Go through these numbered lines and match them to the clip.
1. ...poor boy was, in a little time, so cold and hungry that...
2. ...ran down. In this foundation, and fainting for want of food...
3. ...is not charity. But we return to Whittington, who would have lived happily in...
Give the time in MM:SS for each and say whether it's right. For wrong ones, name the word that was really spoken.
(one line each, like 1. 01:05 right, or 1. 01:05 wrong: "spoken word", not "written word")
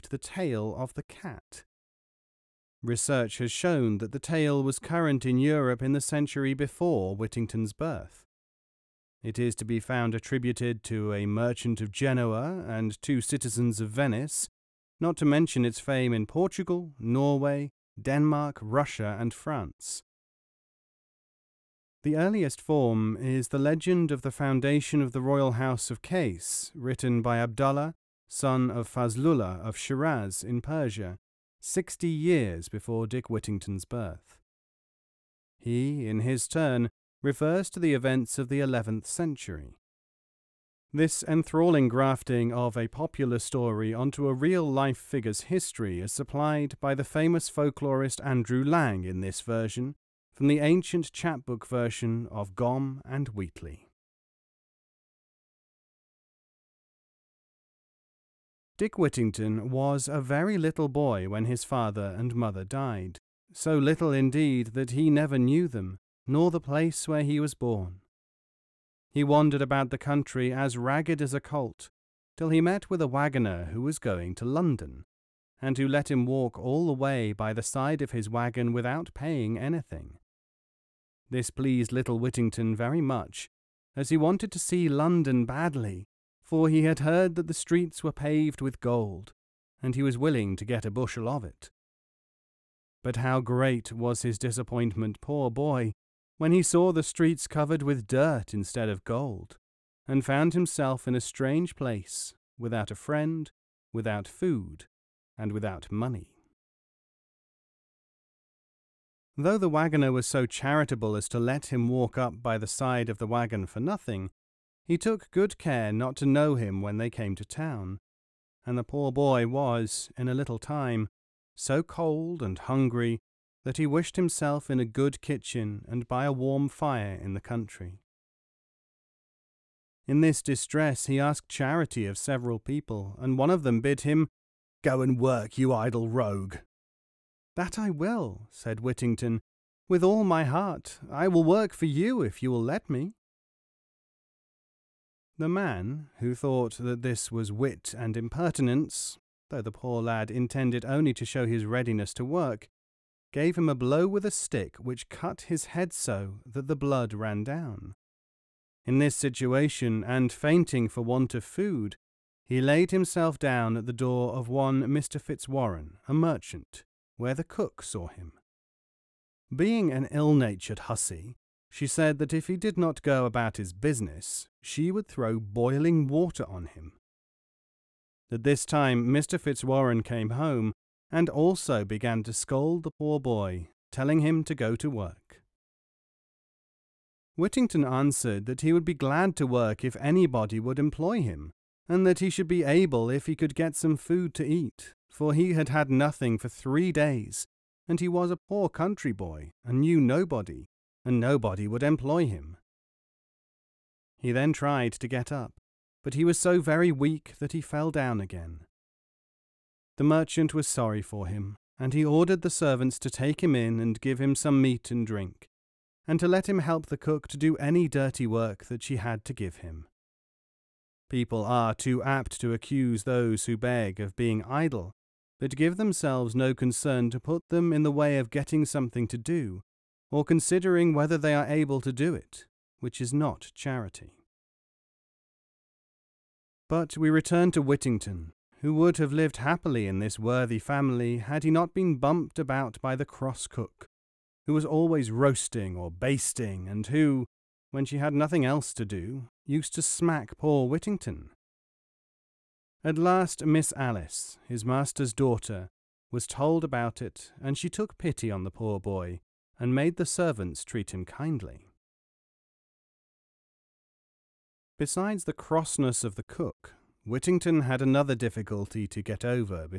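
1. 01:58 right
2. 02:37 wrong: "situation", not "foundation"
3. 03:53 right.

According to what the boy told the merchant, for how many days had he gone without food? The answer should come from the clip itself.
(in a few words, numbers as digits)
3.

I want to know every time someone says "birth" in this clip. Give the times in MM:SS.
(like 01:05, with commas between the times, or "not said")
00:07, 00:33.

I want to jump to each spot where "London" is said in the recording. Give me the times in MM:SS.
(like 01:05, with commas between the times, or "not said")
01:14, 01:24.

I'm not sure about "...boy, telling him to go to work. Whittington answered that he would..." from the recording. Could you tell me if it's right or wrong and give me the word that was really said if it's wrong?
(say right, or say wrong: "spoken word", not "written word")
right.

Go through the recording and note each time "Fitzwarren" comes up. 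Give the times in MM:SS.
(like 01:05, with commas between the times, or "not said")
02:45, 02:59.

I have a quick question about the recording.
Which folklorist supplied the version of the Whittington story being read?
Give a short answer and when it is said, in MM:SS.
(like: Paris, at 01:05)
Andrew Lang, at 00:48.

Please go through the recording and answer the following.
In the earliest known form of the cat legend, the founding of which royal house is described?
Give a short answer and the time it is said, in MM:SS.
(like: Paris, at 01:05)
Case, at 00:25.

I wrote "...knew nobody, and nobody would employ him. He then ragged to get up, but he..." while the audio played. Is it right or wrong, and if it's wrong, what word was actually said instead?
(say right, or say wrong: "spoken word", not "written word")
wrong: "tried", not "ragged".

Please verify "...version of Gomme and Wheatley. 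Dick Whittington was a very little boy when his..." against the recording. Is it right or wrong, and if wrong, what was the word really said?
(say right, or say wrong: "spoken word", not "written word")
right.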